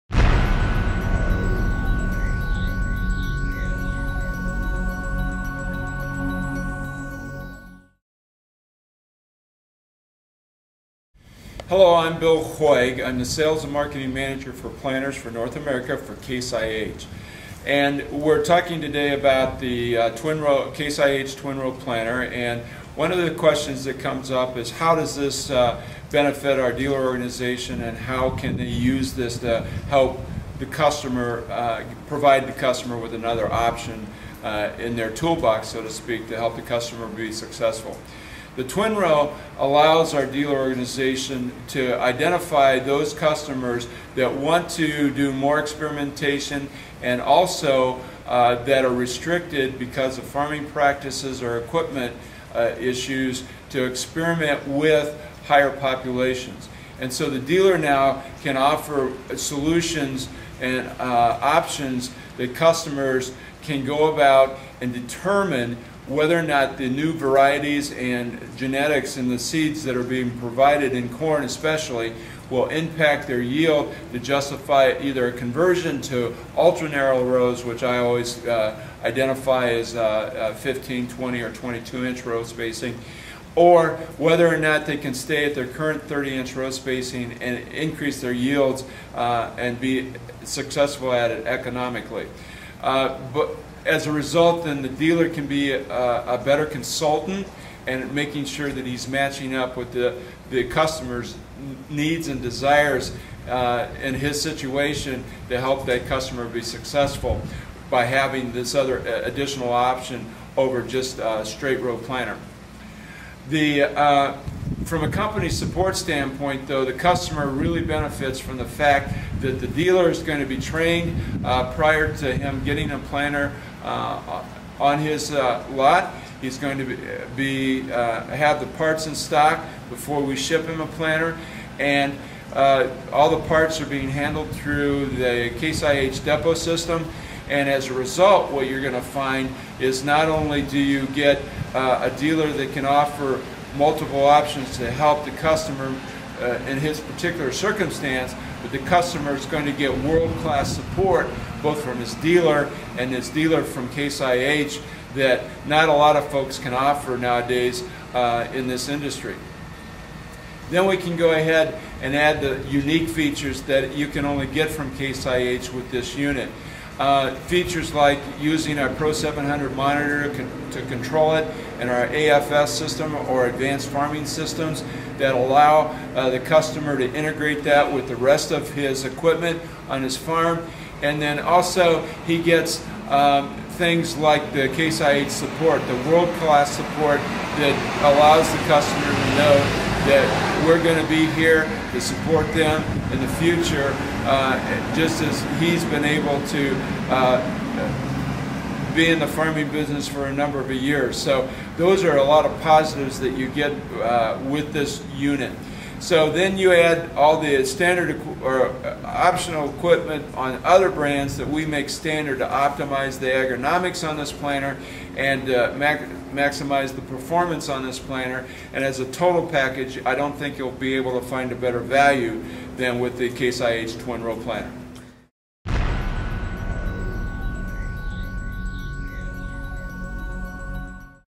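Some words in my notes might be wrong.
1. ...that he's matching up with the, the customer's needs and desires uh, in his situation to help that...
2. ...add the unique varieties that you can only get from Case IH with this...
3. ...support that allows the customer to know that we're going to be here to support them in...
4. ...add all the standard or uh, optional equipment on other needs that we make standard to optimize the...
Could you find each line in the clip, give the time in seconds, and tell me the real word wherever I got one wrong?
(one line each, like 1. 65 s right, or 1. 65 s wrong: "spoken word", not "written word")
1. 98 s right
2. 162 s wrong: "features", not "varieties"
3. 186 s right
4. 206 s wrong: "brands", not "needs".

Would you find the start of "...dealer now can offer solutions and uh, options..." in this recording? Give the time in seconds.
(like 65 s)
57 s.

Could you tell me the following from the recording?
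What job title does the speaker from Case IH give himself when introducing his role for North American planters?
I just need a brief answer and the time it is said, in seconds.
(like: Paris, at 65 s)
Sales and Marketing Manager, at 13 s.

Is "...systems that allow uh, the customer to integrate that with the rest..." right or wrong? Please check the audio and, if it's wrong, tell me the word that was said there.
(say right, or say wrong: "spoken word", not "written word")
right.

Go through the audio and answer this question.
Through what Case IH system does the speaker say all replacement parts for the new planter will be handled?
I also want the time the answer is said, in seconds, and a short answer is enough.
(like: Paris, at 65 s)
depot system, at 136 s.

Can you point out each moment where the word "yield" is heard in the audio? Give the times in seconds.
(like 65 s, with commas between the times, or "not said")
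73 s, 88 s.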